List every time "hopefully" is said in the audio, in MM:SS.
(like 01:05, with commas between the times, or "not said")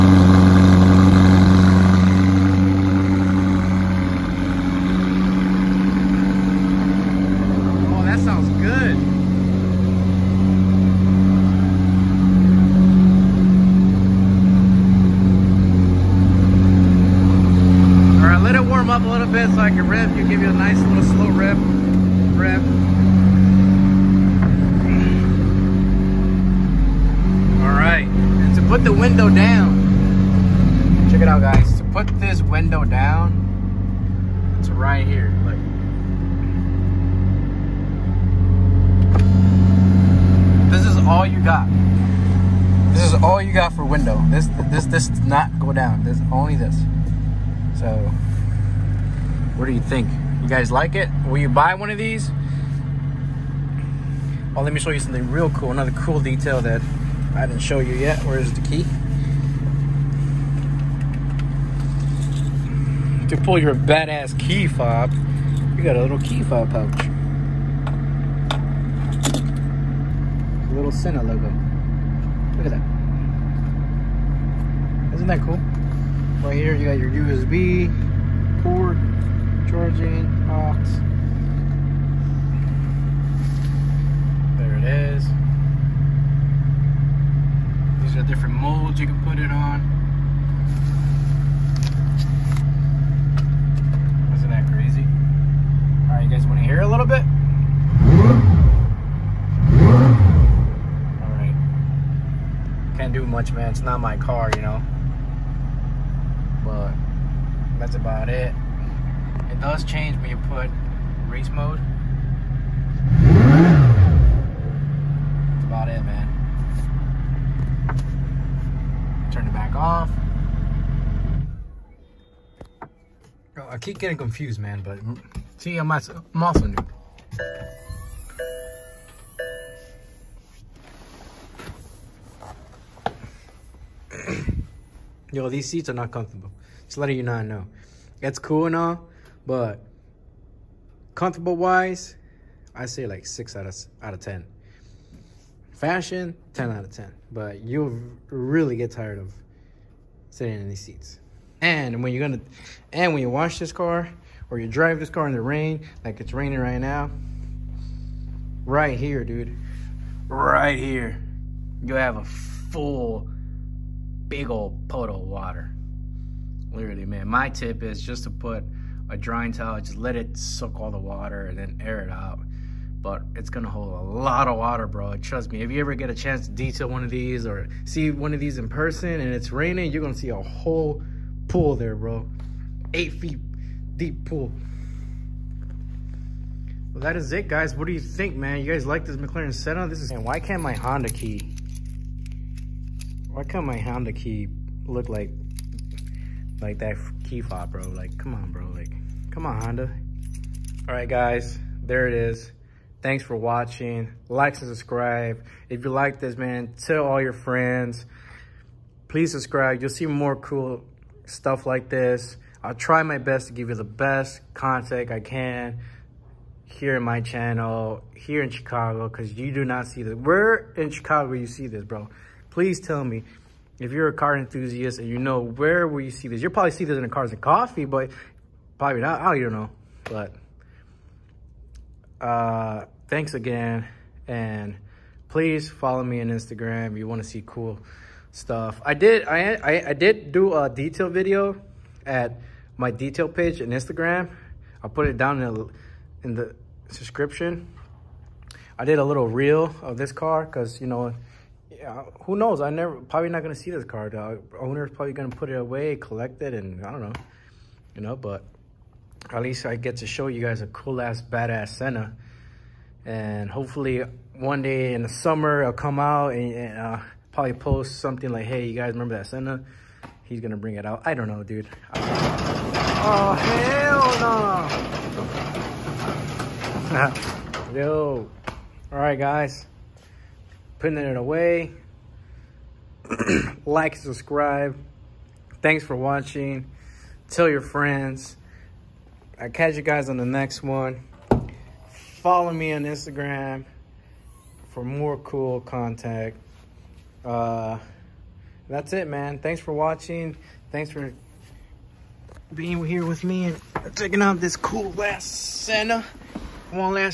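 04:23.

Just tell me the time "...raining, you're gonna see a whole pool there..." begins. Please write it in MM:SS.
02:59.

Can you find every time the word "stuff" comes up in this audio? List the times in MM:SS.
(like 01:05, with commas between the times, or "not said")
03:31, 03:58.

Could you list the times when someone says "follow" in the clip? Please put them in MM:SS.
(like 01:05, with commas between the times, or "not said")
03:55, 04:52.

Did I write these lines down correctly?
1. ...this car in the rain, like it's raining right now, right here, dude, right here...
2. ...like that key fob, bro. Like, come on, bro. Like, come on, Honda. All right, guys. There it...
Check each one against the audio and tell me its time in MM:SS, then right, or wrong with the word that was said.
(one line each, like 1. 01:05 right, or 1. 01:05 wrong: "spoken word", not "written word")
1. 02:34 right
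2. 03:16 right.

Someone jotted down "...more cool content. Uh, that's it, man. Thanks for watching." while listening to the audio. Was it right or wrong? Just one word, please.
right.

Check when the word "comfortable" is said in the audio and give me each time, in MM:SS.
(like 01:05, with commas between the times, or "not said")
02:16, 02:21.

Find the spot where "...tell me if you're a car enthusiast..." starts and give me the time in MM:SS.
03:42.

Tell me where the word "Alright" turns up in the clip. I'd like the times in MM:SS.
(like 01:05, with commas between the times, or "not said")
01:36, 01:41.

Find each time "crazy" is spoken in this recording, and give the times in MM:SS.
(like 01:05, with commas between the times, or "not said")
01:34.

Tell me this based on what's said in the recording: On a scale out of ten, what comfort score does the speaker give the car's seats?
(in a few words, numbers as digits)
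6.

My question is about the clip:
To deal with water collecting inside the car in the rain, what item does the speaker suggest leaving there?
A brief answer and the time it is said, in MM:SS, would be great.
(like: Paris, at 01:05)
drying towel, at 02:49.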